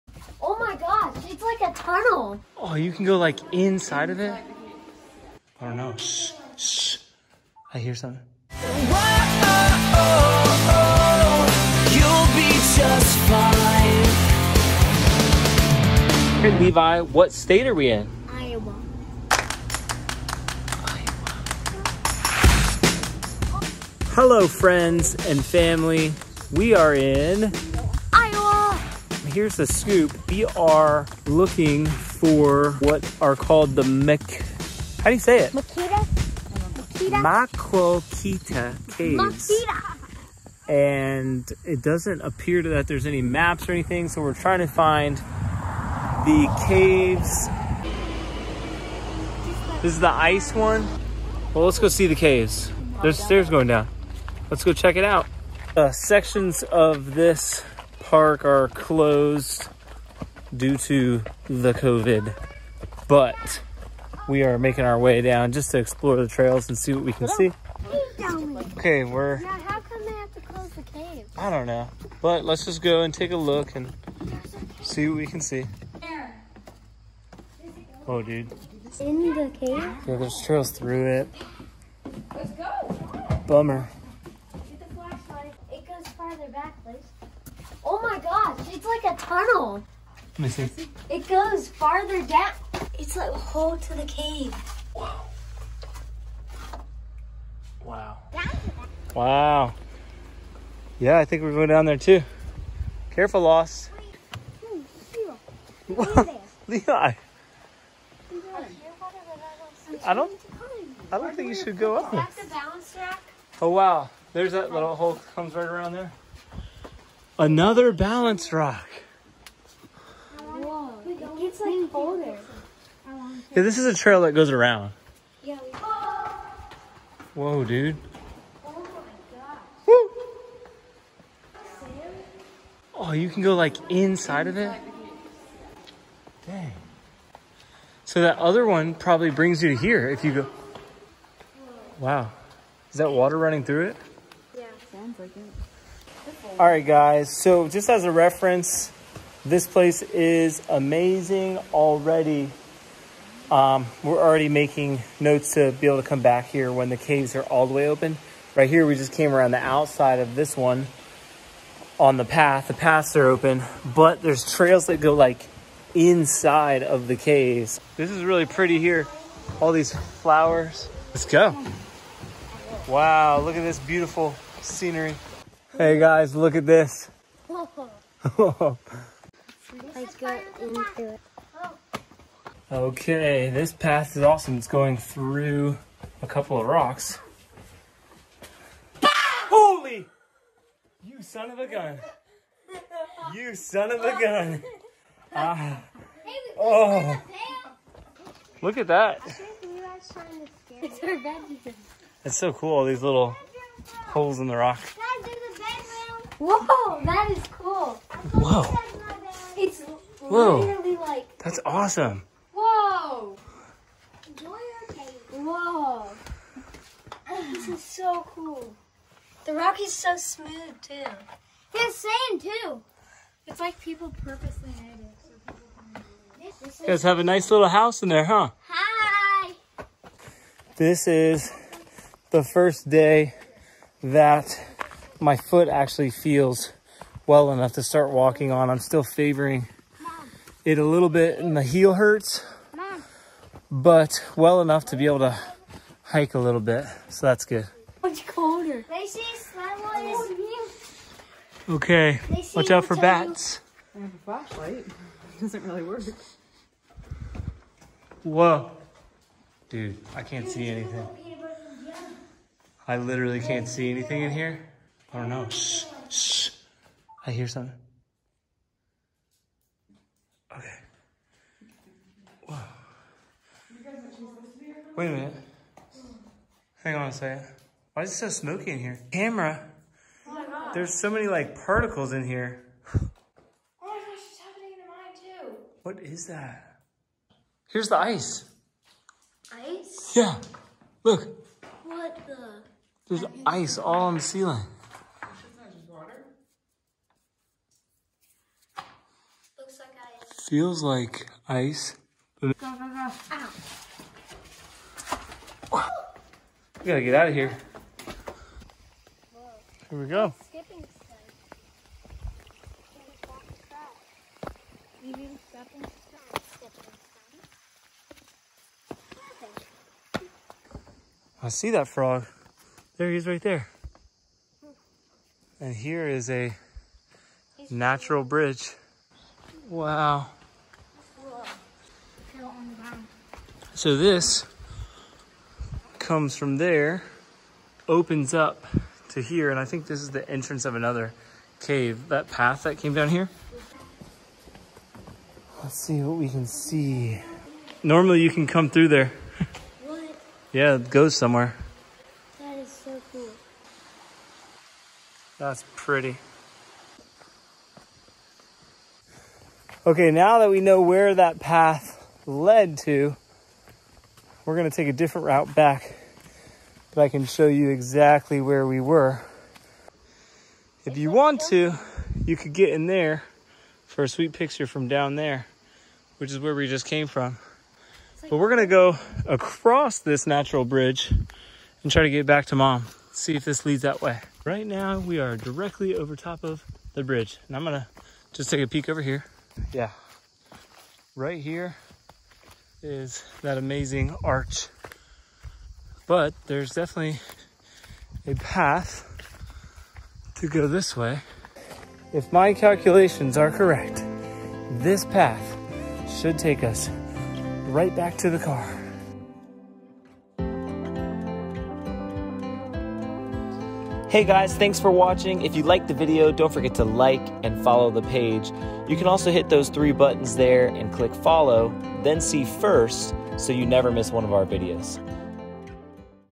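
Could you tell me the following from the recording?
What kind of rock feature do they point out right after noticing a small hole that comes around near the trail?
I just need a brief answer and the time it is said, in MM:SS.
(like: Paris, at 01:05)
balance rock, at 01:57.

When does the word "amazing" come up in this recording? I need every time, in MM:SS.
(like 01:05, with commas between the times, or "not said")
02:30, 06:33.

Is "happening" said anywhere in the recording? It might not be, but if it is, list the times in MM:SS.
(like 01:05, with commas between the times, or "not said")
04:44.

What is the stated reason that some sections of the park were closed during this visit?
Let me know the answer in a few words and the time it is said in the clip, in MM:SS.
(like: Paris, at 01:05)
COVID, at 01:01.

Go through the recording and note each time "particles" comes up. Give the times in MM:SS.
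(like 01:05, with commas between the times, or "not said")
04:41.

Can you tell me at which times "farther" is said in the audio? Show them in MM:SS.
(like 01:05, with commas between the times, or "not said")
01:26, 01:31.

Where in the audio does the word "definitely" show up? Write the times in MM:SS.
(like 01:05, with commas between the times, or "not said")
06:36.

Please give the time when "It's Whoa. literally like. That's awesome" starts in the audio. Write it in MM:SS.
03:29.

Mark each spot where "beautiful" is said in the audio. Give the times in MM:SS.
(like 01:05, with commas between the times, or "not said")
02:53.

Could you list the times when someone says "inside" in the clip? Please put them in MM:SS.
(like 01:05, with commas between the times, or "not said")
00:03, 02:13, 02:45.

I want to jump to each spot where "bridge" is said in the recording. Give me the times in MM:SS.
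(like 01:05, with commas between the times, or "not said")
05:28, 06:20, 06:27.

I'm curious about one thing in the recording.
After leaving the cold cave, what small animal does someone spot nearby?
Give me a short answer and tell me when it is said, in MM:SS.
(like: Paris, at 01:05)
frog, at 05:21.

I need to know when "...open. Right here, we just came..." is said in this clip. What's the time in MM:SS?
02:37.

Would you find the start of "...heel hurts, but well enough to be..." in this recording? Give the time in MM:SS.
04:01.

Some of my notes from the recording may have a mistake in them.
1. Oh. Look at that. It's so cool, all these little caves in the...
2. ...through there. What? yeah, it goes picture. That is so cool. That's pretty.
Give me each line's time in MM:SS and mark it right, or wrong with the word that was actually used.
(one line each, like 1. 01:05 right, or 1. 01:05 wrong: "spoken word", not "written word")
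1. 03:16 wrong: "holes", not "caves"
2. 05:48 wrong: "somewhere", not "picture".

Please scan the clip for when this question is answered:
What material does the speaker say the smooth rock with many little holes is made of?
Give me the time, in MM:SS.
03:41.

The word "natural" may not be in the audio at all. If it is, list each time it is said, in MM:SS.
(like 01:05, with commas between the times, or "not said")
05:27, 06:20.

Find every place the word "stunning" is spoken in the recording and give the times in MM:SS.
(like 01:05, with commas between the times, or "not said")
not said.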